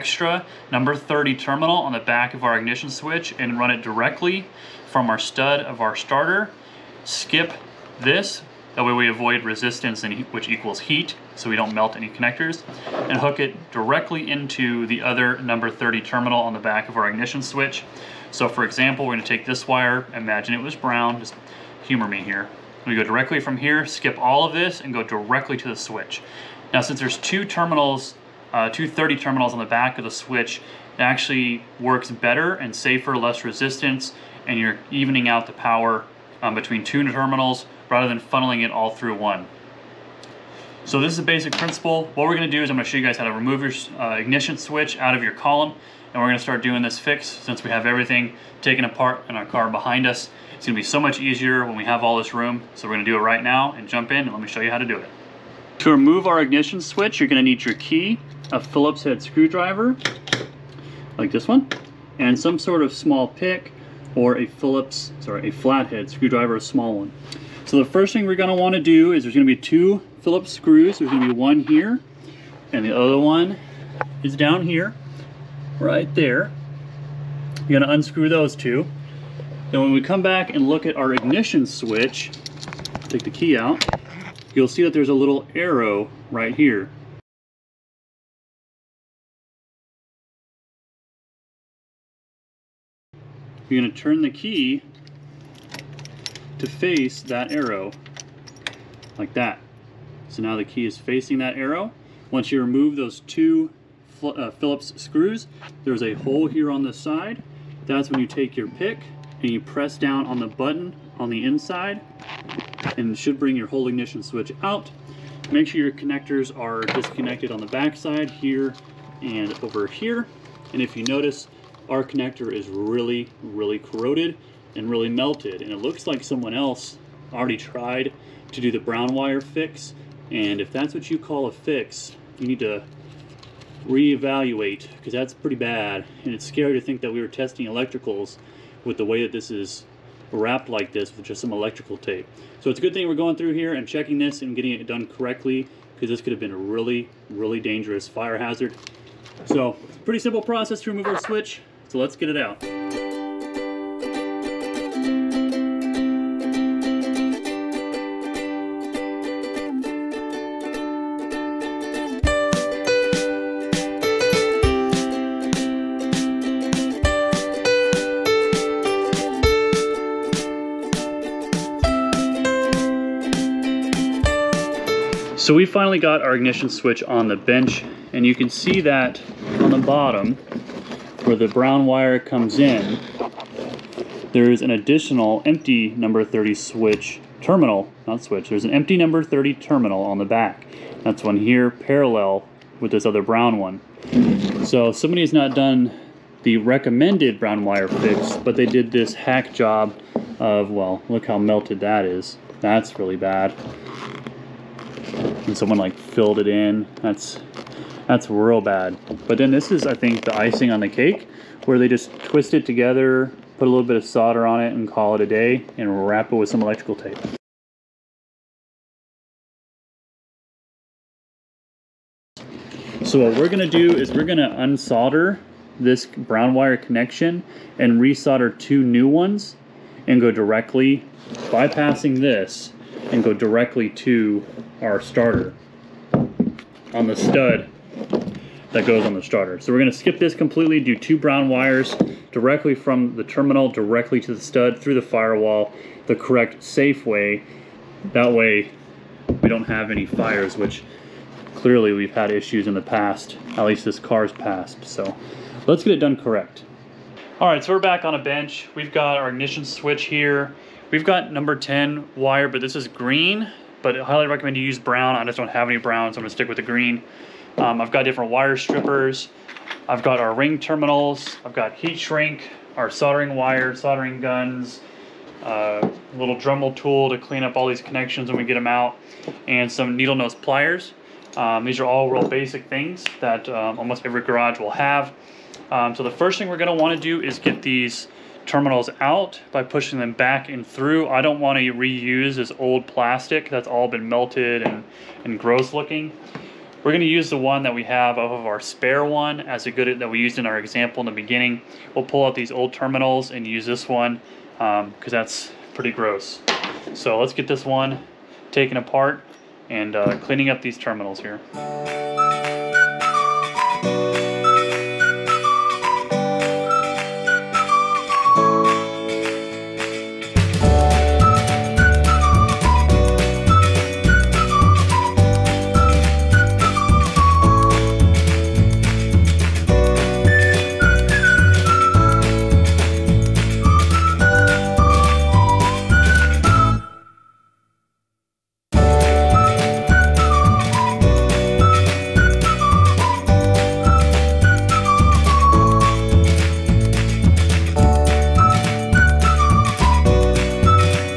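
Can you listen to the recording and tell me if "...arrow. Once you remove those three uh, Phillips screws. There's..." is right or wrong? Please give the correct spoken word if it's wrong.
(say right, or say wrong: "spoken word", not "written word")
wrong: "two", not "three".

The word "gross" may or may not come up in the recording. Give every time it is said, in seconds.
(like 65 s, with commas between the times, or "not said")
295 s, 305 s.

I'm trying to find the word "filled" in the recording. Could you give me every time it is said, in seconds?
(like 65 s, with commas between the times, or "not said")
205 s.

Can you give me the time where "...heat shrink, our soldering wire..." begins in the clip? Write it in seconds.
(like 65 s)
271 s.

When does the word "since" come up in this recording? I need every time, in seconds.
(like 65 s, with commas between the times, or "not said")
26 s, 47 s.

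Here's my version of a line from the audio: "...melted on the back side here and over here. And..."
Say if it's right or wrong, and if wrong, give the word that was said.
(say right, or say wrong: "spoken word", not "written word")
wrong: "disconnected", not "melted".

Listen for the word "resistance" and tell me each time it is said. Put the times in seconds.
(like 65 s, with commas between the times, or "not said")
9 s, 33 s.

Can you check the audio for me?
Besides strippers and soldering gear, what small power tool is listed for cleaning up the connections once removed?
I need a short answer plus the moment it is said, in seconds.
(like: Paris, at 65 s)
Dremel tool, at 276 s.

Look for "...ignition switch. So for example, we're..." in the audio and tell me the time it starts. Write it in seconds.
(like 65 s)
17 s.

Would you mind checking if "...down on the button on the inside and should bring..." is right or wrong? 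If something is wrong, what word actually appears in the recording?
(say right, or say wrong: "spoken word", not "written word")
right.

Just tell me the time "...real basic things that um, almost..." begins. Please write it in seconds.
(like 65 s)
282 s.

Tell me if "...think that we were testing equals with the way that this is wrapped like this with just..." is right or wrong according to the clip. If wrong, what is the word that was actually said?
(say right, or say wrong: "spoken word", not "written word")
wrong: "electricals", not "equals".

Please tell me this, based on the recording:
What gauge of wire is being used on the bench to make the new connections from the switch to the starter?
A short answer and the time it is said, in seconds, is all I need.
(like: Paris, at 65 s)
10, at 261 s.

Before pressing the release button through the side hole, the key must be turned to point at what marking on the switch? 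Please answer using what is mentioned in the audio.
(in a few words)
a little arrow.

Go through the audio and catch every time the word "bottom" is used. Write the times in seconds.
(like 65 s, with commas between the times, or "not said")
179 s.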